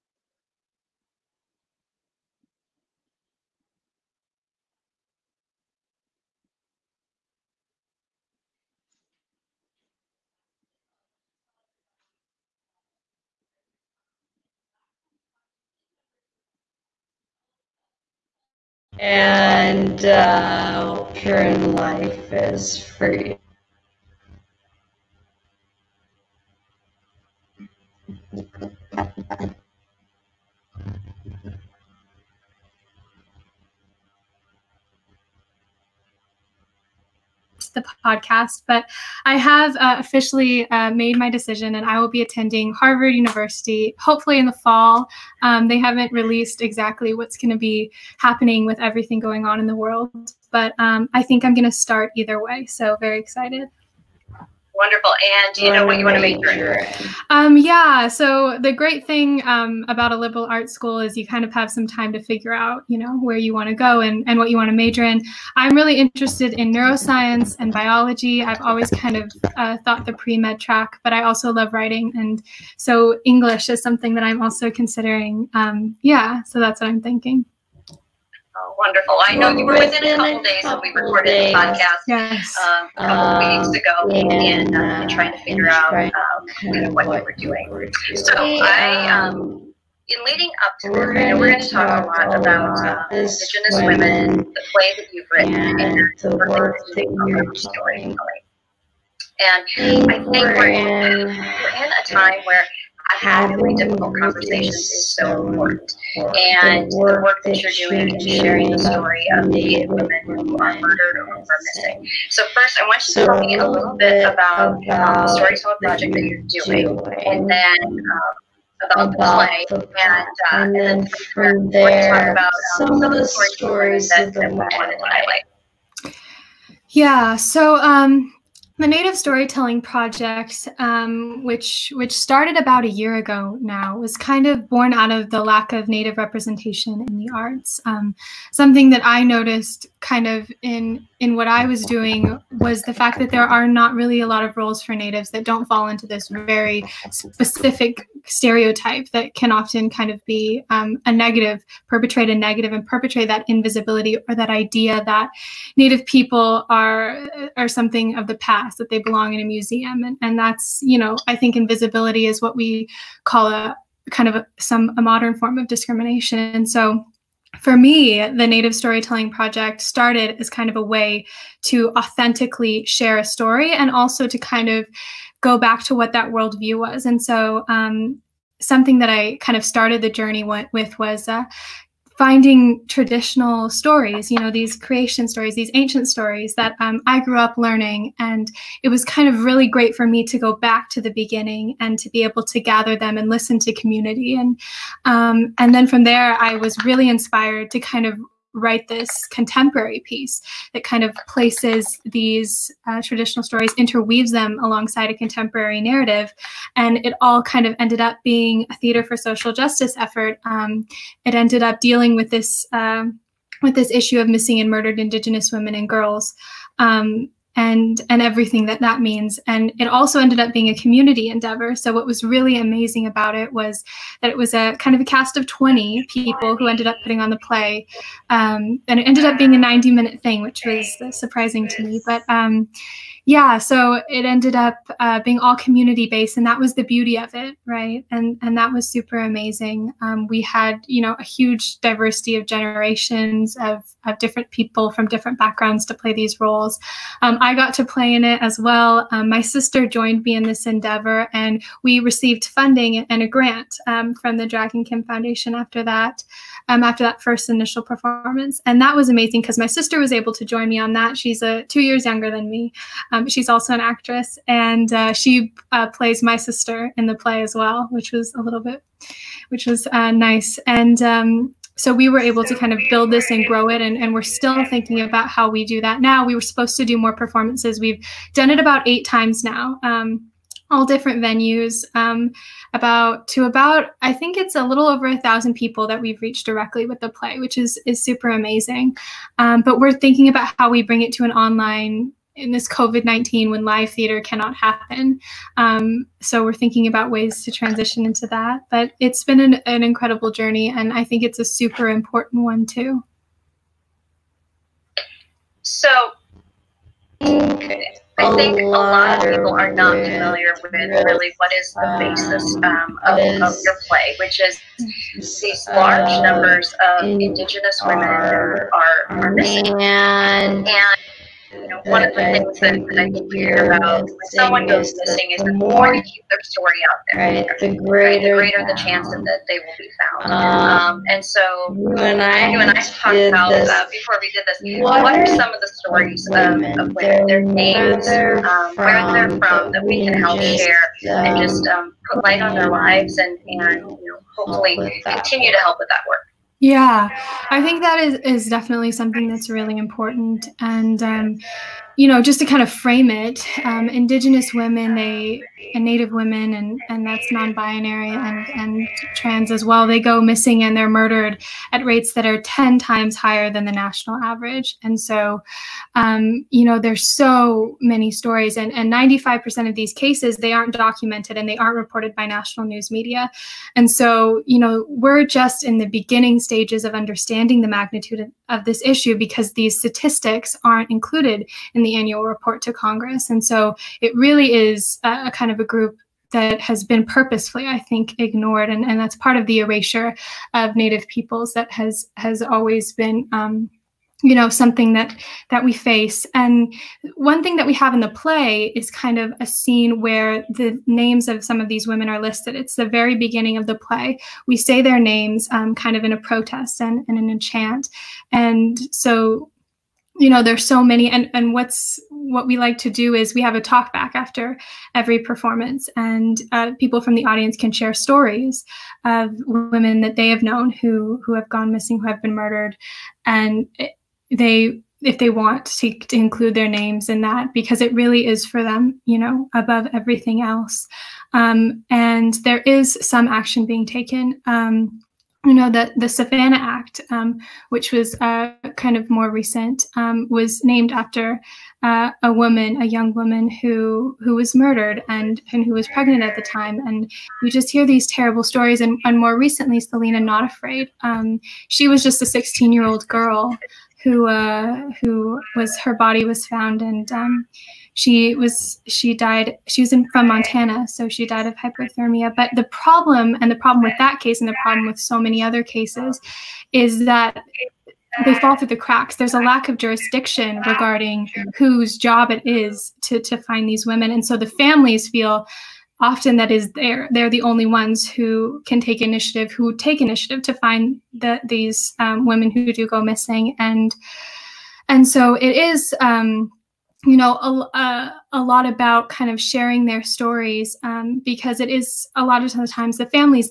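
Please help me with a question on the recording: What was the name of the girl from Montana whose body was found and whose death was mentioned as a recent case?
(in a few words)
Selena Not Afraid.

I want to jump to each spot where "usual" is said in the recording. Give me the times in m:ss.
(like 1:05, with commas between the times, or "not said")
not said.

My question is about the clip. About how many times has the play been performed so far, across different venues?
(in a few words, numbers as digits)
8.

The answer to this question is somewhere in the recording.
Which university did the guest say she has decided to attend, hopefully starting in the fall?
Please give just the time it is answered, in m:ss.
0:42.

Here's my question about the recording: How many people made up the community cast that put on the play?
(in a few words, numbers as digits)
20.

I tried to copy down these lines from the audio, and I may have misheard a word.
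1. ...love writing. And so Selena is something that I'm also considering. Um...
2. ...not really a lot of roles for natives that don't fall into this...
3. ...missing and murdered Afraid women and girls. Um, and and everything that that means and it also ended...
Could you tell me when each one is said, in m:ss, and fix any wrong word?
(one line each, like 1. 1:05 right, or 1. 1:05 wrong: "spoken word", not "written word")
1. 1:11 wrong: "English", not "Selena"
2. 2:23 right
3. 3:34 wrong: "Indigenous", not "Afraid".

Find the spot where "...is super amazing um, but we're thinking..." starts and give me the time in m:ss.
4:47.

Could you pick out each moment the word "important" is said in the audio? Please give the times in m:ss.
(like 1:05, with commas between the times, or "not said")
1:45, 5:01, 5:49.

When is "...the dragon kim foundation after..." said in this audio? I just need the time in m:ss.
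4:14.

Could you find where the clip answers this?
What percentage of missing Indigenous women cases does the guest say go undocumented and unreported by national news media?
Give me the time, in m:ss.
6:08.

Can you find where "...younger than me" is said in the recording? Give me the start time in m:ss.
4:22.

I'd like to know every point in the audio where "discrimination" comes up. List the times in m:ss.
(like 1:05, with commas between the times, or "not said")
2:45.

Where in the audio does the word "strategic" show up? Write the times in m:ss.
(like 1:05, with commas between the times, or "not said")
not said.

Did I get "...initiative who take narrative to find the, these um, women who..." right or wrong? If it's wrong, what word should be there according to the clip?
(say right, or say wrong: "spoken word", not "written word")
wrong: "initiative", not "narrative".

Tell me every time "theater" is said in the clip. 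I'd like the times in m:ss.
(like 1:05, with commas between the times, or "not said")
3:28, 4:53.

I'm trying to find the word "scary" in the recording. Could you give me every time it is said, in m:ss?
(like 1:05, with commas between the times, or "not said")
not said.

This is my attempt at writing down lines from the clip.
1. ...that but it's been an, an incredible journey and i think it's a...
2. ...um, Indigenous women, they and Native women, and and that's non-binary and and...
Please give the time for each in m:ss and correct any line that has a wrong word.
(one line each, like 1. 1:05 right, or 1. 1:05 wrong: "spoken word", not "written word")
1. 4:58 right
2. 5:53 right.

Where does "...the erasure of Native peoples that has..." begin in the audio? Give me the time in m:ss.
6:29.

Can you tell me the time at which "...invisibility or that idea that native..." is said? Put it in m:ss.
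2:33.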